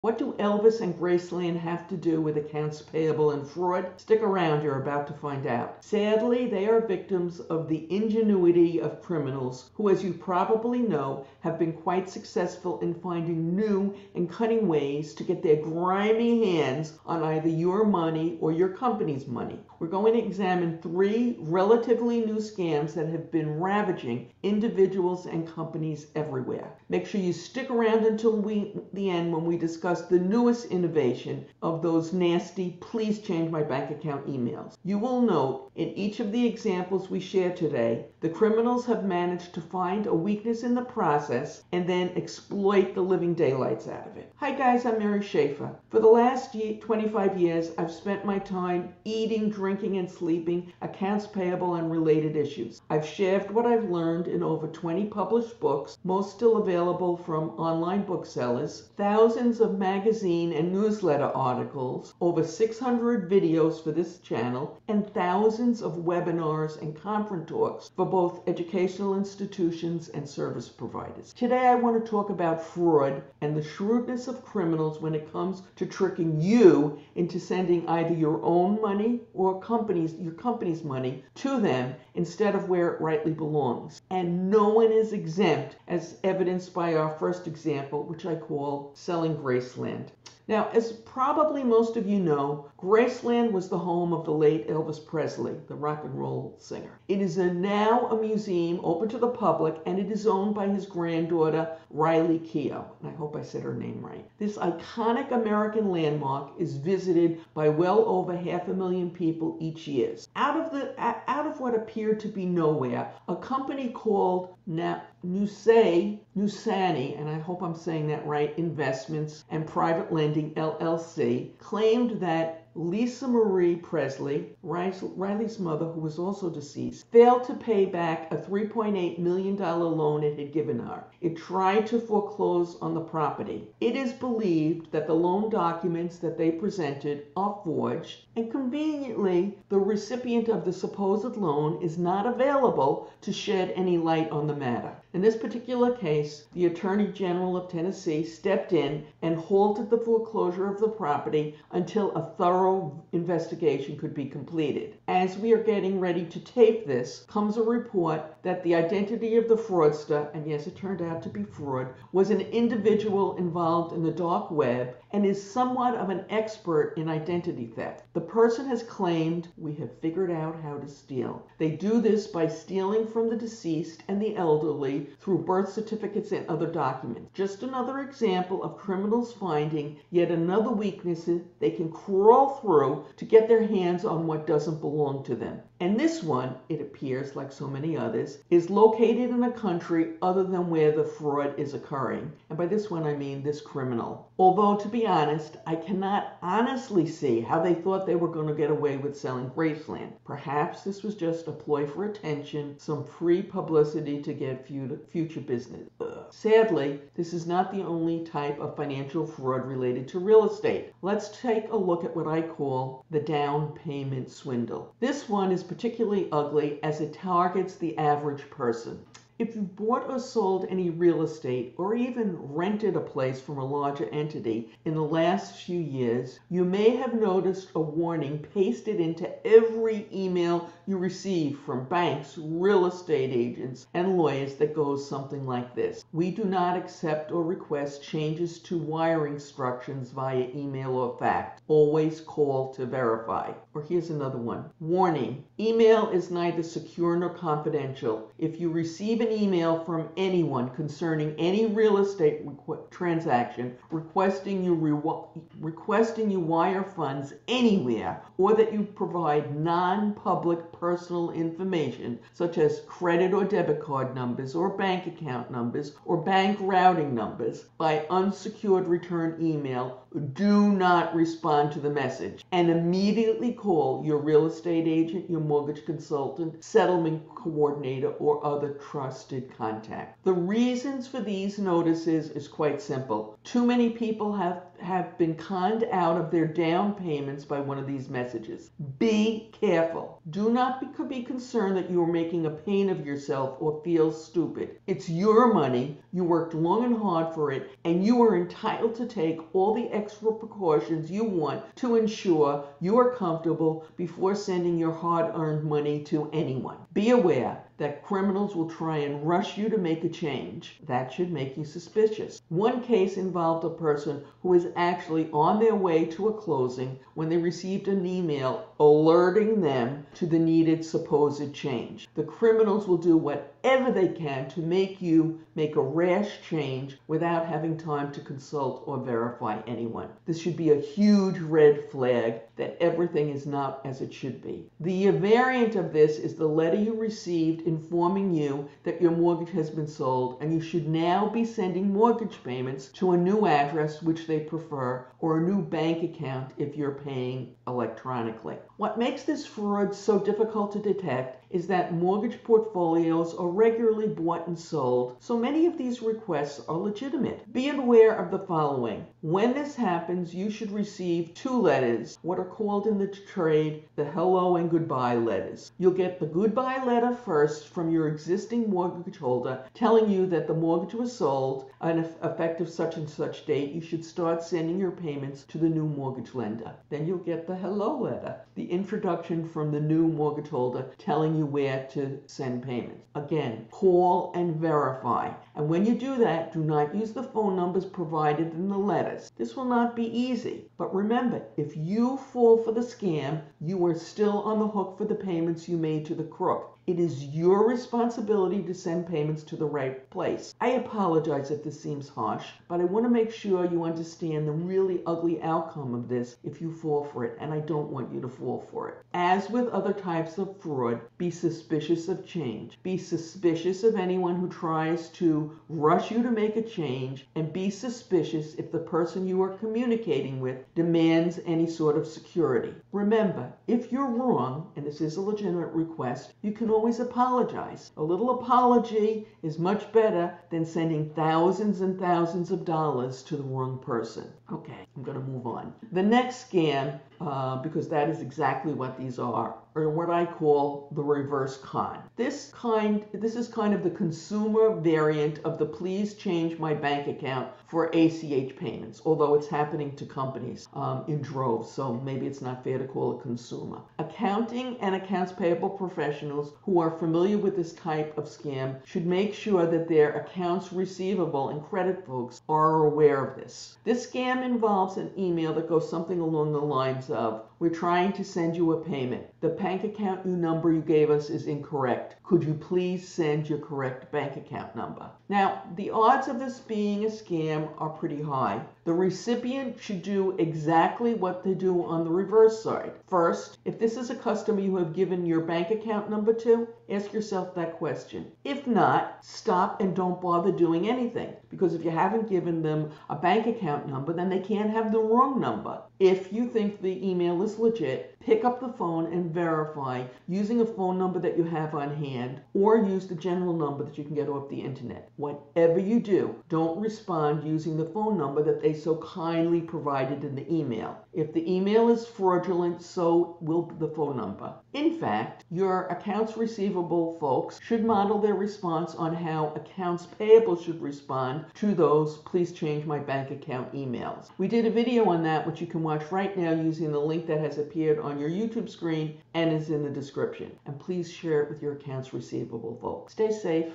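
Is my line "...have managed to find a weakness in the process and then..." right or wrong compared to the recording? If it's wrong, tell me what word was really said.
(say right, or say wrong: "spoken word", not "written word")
right.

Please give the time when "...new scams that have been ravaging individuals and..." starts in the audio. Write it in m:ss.
0:22.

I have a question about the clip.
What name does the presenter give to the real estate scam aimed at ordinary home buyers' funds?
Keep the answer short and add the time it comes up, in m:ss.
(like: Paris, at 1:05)
the down payment swindle, at 3:33.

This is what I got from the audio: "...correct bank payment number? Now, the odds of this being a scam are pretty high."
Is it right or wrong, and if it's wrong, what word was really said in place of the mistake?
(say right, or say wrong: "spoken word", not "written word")
wrong: "account", not "payment".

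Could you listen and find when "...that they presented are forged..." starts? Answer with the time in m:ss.
2:16.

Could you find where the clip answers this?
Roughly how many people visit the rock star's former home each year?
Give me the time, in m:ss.
1:47.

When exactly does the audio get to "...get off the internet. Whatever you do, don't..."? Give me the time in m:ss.
8:24.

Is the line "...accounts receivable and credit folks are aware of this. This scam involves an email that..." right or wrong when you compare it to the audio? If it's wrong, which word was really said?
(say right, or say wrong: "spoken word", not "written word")
right.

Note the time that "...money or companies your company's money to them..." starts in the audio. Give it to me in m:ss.
1:18.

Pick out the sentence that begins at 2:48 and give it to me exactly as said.
The person has claimed, We have figured out how to steal.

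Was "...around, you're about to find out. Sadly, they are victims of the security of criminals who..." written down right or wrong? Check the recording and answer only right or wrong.
wrong.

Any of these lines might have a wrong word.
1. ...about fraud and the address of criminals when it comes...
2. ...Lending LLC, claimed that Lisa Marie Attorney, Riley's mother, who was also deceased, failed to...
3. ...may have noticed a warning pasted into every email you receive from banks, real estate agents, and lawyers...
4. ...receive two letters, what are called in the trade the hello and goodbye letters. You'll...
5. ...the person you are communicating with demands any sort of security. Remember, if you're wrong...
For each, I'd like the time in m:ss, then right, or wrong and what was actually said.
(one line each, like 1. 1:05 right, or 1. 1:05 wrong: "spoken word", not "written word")
1. 1:12 wrong: "shrewdness", not "address"
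2. 2:00 wrong: "Presley", not "Attorney"
3. 3:46 right
4. 6:00 right
5. 6:58 right.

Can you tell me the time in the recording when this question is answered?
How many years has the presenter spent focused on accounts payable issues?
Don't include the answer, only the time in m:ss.
0:46.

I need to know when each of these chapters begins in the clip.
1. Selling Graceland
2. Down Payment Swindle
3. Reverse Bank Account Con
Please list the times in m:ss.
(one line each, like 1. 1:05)
1. 1:29
2. 3:34
3. 7:18.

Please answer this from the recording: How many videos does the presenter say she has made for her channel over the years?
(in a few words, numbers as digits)
over 600.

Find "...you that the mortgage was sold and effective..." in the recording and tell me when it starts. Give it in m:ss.
6:10.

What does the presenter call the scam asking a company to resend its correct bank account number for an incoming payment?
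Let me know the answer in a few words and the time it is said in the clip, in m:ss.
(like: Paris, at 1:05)
the reverse con, at 7:20.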